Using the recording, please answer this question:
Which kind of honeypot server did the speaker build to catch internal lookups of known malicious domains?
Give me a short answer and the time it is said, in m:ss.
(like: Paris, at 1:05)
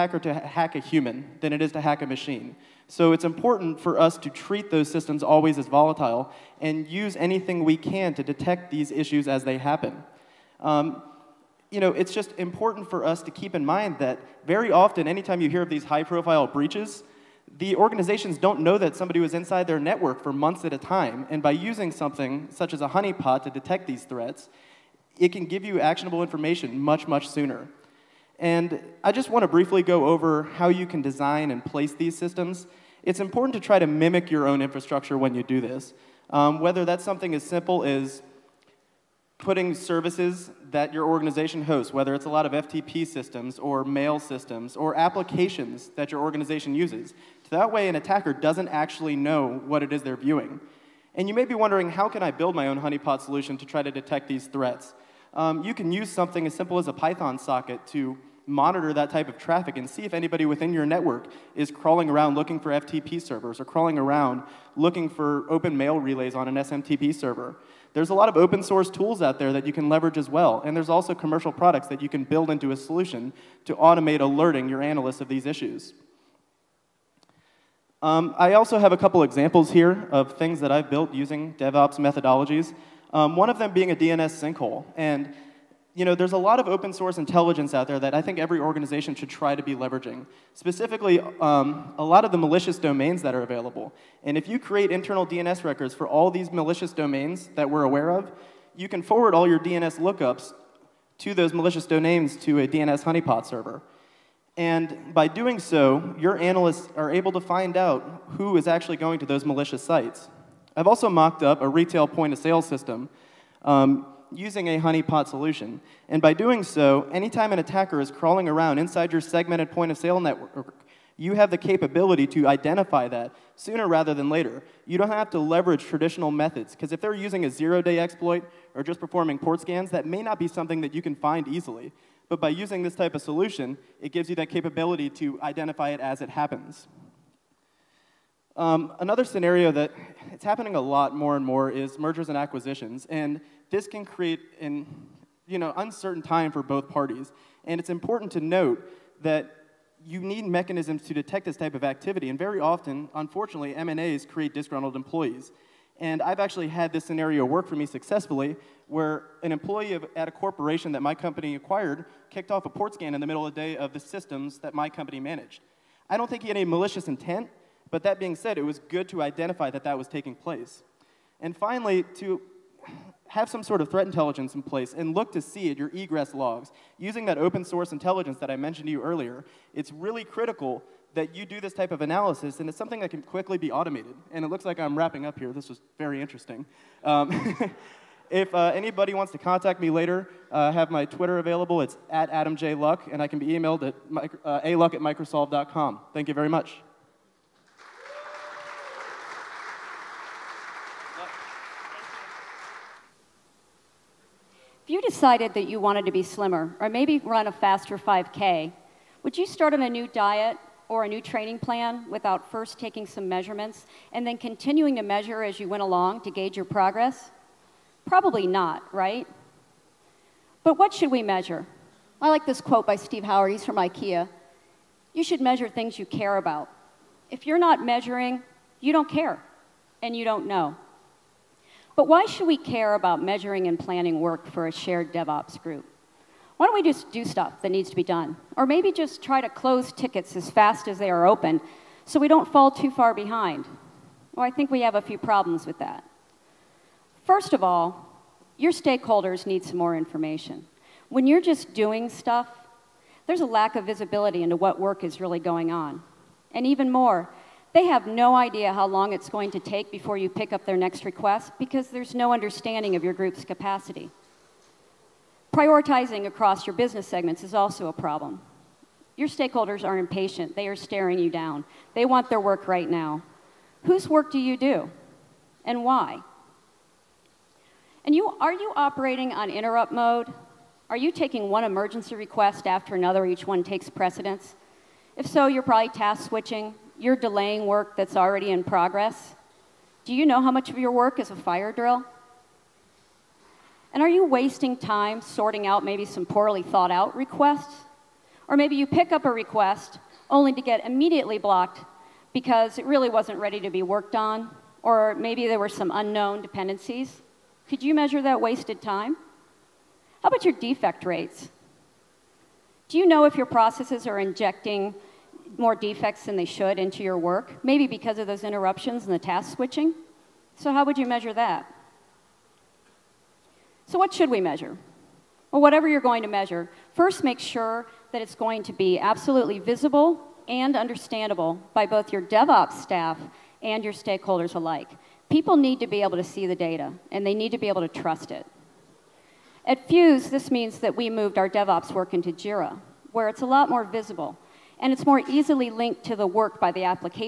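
DNS sinkhole, at 1:23.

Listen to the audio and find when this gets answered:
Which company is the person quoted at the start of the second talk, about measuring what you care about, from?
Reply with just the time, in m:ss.
3:43.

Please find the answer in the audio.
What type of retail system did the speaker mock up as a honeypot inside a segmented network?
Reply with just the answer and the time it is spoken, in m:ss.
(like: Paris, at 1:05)
point of sale system, at 1:52.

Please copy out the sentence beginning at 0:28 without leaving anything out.
And I just want to briefly go over how you can design and place these systems.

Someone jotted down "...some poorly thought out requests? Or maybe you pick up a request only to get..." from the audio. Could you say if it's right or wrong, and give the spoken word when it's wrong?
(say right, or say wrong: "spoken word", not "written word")
right.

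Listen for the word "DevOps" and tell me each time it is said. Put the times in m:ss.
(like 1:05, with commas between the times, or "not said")
1:21, 3:55, 5:32, 5:41.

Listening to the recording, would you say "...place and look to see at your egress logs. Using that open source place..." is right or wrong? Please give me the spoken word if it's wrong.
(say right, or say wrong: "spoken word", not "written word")
wrong: "intelligence", not "place".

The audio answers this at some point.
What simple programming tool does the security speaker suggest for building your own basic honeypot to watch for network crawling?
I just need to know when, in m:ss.
0:56.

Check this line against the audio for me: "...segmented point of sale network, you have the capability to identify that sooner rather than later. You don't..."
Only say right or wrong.
right.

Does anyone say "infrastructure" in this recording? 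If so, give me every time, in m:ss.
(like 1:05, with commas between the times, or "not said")
0:34.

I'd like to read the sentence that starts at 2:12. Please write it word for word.
But by using this type of solution, it gives you that capability to identify it as it happens.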